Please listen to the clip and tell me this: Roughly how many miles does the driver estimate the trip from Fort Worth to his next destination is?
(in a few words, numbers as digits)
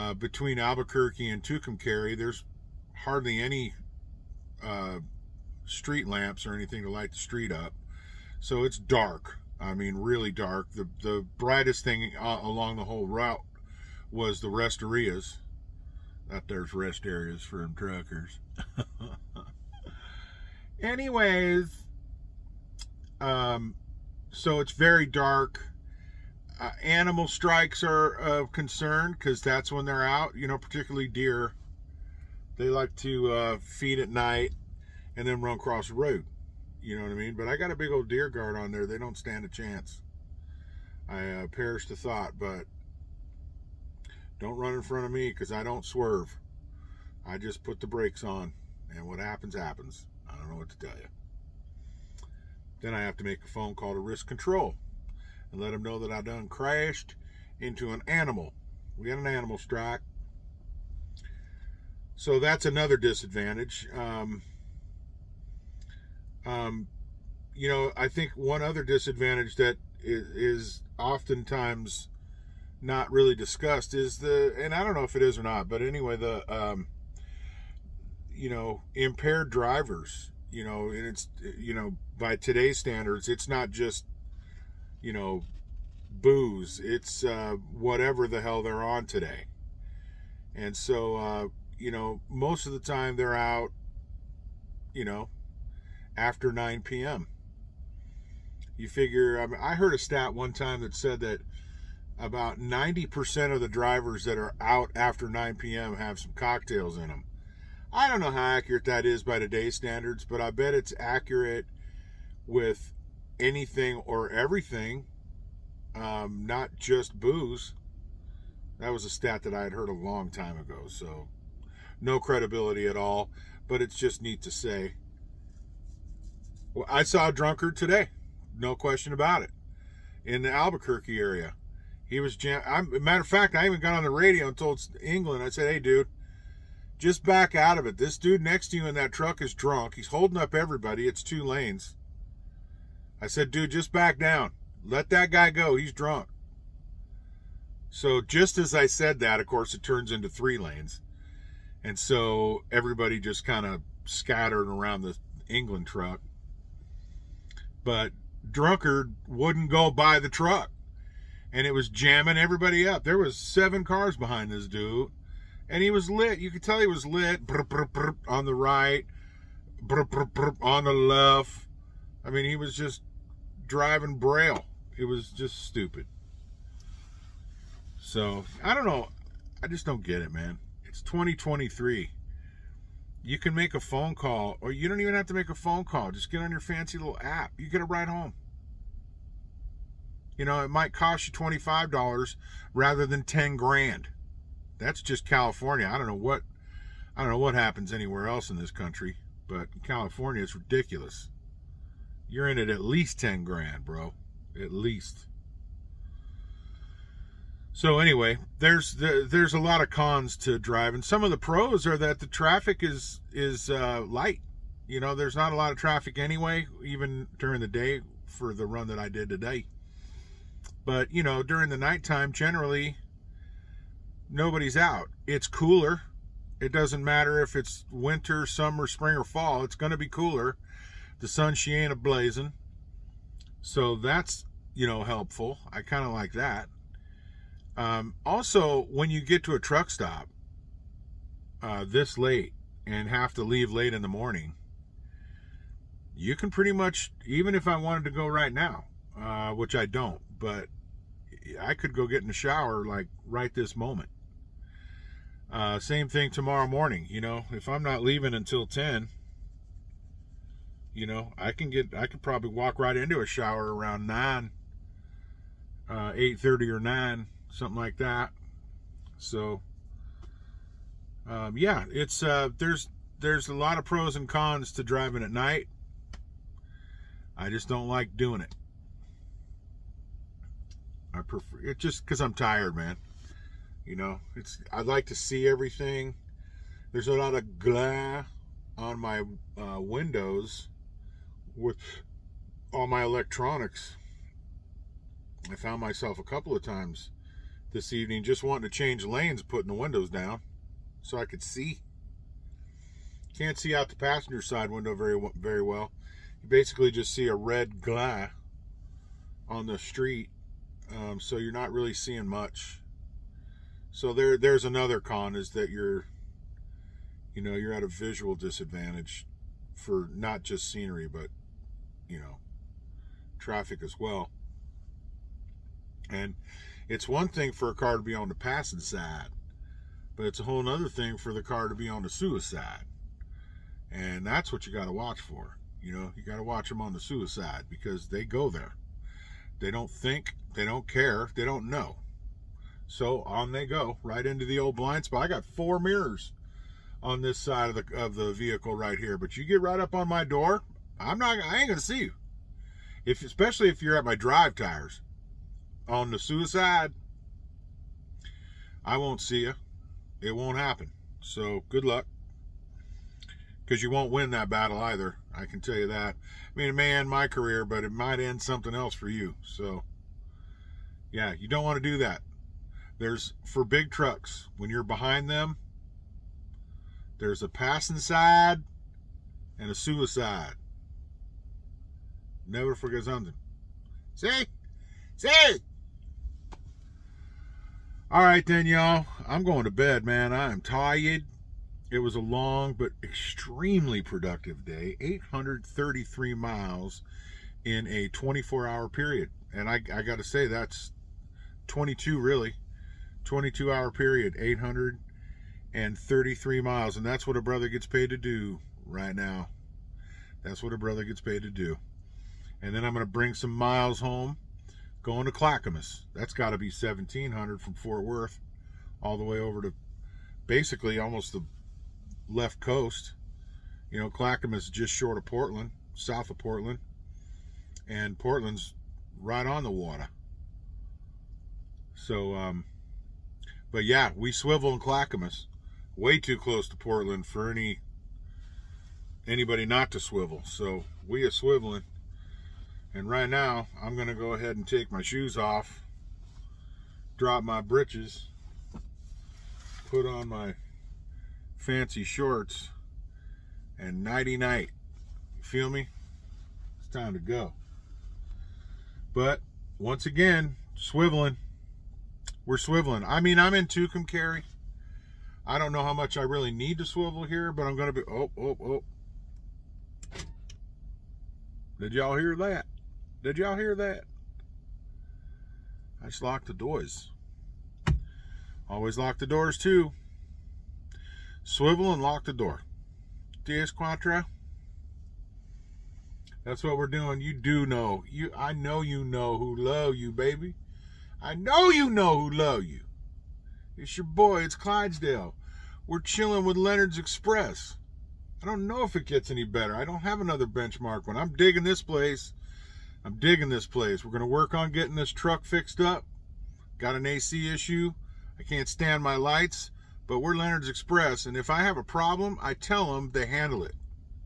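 1,700.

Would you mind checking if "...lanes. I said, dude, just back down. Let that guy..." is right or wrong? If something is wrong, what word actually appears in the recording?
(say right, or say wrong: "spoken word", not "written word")
right.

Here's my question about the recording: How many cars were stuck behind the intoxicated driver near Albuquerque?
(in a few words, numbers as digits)
7.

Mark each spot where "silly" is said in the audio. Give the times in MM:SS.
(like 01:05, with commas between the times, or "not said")
not said.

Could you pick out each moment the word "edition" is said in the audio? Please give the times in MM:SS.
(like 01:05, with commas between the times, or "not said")
not said.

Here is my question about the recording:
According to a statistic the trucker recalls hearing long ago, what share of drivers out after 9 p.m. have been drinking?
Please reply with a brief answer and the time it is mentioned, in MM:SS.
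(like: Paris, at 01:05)
90%, at 01:42.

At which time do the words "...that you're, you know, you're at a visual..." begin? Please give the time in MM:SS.
05:15.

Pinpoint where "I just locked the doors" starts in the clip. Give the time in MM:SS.
07:56.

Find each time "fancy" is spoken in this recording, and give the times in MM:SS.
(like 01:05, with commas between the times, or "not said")
03:06, 07:31.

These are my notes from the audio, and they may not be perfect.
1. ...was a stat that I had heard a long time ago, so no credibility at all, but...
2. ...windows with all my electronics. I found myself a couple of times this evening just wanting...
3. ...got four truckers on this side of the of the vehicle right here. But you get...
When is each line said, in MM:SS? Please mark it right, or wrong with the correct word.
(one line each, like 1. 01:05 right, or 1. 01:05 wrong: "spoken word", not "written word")
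1. 01:58 right
2. 04:49 right
3. 05:45 wrong: "mirrors", not "truckers".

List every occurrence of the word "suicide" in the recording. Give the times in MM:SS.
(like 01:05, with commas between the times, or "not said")
05:32, 05:36, 05:56, 06:19.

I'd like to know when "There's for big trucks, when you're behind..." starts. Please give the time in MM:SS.
06:12.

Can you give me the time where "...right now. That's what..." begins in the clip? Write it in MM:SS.
06:48.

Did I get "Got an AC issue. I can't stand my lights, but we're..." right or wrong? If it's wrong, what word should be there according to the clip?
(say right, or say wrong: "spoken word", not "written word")
right.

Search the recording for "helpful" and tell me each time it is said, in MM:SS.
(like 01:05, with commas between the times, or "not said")
03:55.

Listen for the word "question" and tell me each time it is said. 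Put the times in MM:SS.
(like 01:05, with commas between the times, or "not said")
02:08.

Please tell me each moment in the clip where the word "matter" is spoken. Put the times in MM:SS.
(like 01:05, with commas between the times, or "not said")
02:13, 03:47.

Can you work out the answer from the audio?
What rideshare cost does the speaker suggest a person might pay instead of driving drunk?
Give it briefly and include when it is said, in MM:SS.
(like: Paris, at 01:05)
$25, at 03:11.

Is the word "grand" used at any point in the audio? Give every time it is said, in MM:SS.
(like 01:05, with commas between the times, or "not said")
03:13, 03:23.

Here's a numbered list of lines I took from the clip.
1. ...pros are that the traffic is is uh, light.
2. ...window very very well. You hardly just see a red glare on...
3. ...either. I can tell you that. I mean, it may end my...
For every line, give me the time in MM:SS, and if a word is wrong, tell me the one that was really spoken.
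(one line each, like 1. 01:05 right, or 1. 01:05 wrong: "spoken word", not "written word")
1. 03:31 right
2. 05:04 wrong: "basically", not "hardly"
3. 06:04 right.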